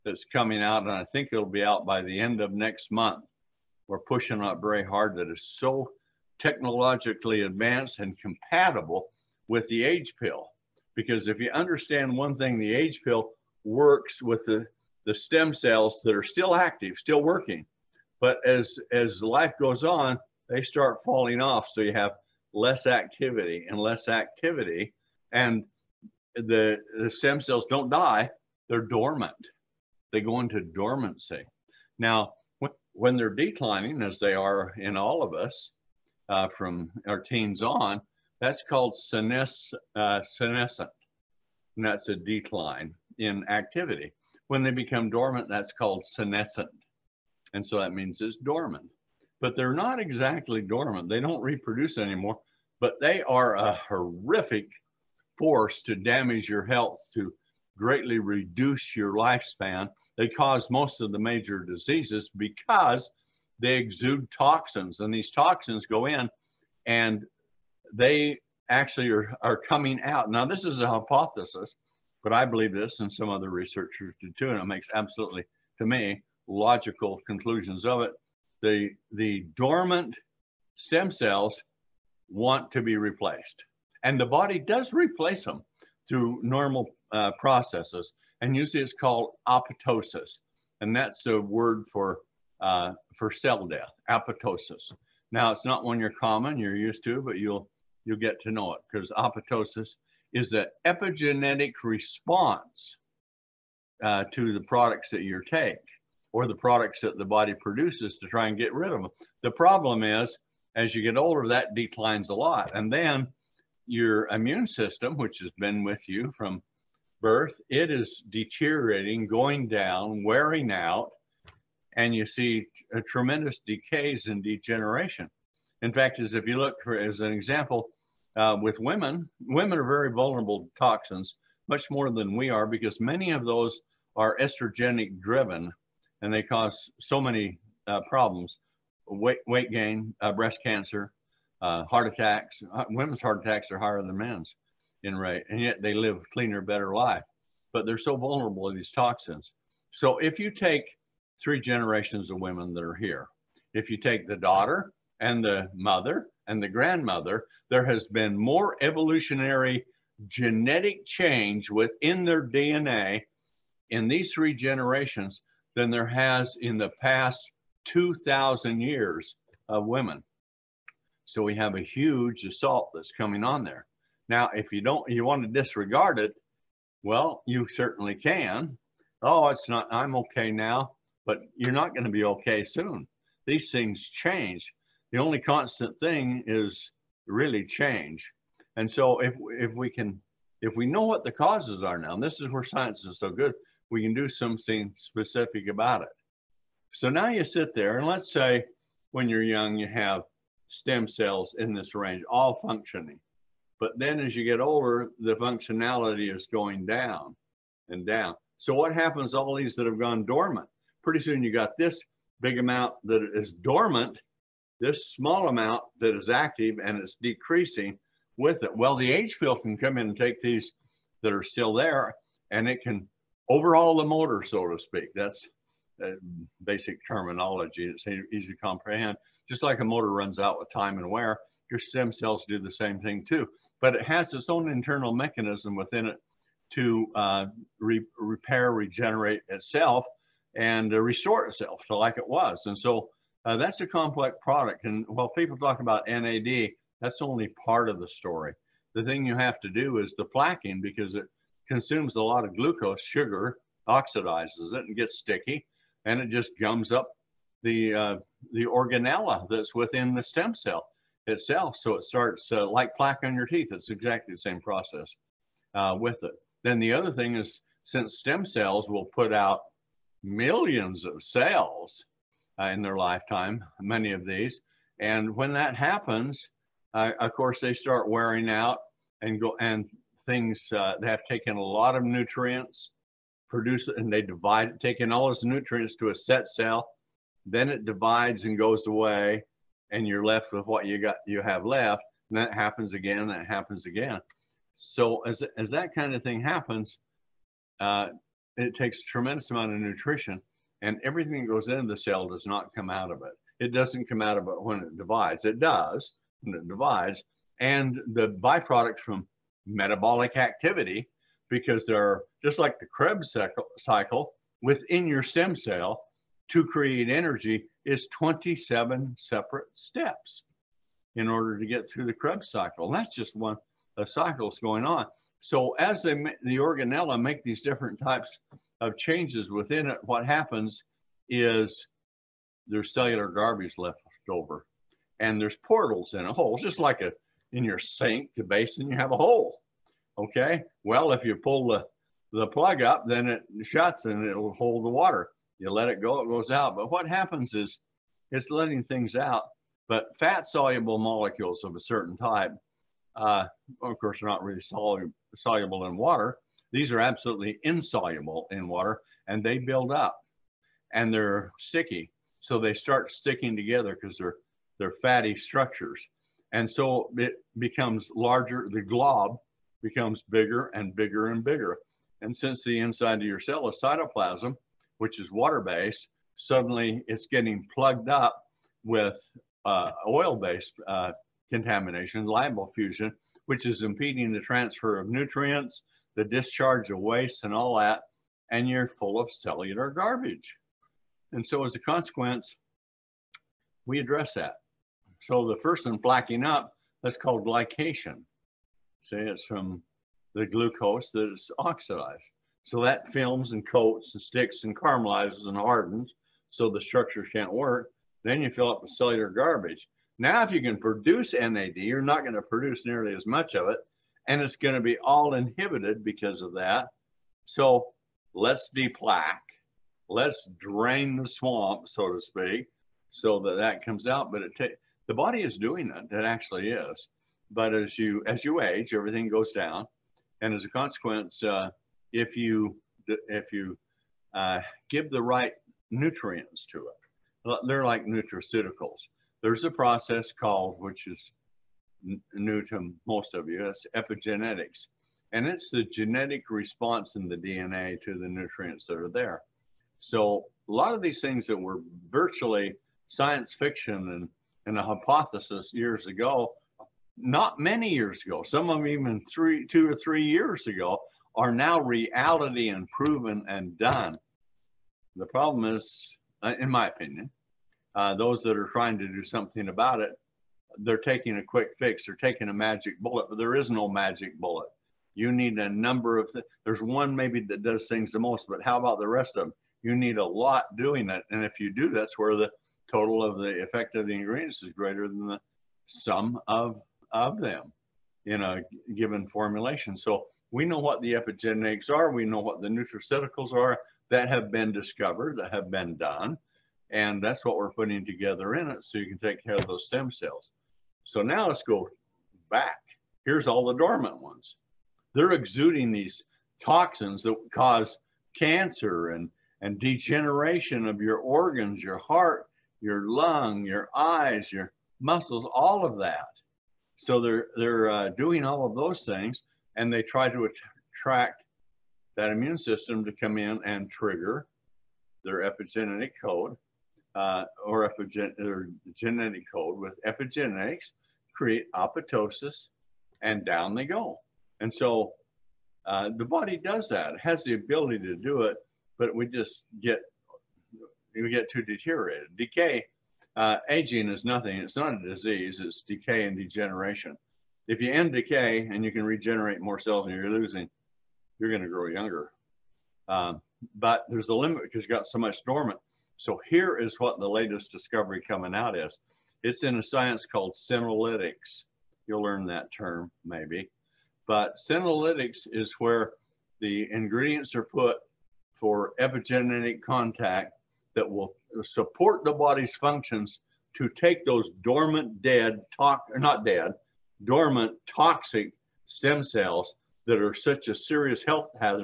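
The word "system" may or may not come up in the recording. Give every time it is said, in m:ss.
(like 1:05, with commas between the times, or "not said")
1:54, 8:42.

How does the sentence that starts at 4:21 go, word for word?
So it starts uh, like plaque on your teeth.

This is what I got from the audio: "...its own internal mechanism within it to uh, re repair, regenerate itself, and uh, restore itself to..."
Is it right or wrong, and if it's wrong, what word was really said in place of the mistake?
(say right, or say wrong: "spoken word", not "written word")
right.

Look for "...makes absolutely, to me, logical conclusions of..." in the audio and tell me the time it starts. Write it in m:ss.
1:14.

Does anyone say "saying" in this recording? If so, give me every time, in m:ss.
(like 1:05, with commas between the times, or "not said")
not said.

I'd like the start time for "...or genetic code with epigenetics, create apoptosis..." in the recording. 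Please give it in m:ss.
8:48.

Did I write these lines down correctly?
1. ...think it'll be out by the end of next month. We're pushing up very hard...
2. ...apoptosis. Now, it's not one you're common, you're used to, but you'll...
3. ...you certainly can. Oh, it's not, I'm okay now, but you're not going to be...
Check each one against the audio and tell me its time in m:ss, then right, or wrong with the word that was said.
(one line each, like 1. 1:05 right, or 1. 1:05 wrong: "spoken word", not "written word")
1. 0:01 right
2. 1:34 right
3. 2:57 right.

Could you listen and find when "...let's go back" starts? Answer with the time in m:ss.
8:21.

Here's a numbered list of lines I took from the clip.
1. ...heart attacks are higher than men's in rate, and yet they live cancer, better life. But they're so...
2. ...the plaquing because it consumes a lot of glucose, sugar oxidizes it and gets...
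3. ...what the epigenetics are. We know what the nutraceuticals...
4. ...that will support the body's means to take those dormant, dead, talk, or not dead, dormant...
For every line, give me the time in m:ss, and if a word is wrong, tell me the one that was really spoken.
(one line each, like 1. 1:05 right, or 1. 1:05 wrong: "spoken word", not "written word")
1. 2:23 wrong: "cleaner", not "cancer"
2. 4:10 right
3. 8:10 right
4. 9:30 wrong: "functions", not "means".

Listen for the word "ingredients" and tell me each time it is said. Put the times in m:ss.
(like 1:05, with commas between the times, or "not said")
8:04, 9:26.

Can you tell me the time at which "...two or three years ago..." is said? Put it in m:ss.
7:39.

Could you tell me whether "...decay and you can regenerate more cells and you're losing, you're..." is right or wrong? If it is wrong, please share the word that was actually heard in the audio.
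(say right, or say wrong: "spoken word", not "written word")
right.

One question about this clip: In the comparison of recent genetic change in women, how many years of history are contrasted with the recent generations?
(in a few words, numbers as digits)
2,000.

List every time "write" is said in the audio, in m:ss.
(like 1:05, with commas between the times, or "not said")
not said.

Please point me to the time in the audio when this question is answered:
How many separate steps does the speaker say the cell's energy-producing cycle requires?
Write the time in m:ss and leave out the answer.
5:18.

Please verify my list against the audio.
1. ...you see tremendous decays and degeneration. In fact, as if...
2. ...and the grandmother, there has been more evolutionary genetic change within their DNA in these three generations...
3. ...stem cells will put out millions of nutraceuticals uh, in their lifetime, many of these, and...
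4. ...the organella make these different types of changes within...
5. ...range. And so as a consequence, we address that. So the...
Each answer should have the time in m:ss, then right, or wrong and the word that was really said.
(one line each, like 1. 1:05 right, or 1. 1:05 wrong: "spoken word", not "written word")
1. 2:02 right
2. 2:36 right
3. 4:28 wrong: "cells", not "nutraceuticals"
4. 5:26 right
5. 6:29 wrong: "garbage", not "range".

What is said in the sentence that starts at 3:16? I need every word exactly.
So now you sit there and let's say when you're young, you have stem cells in this range, all functioning.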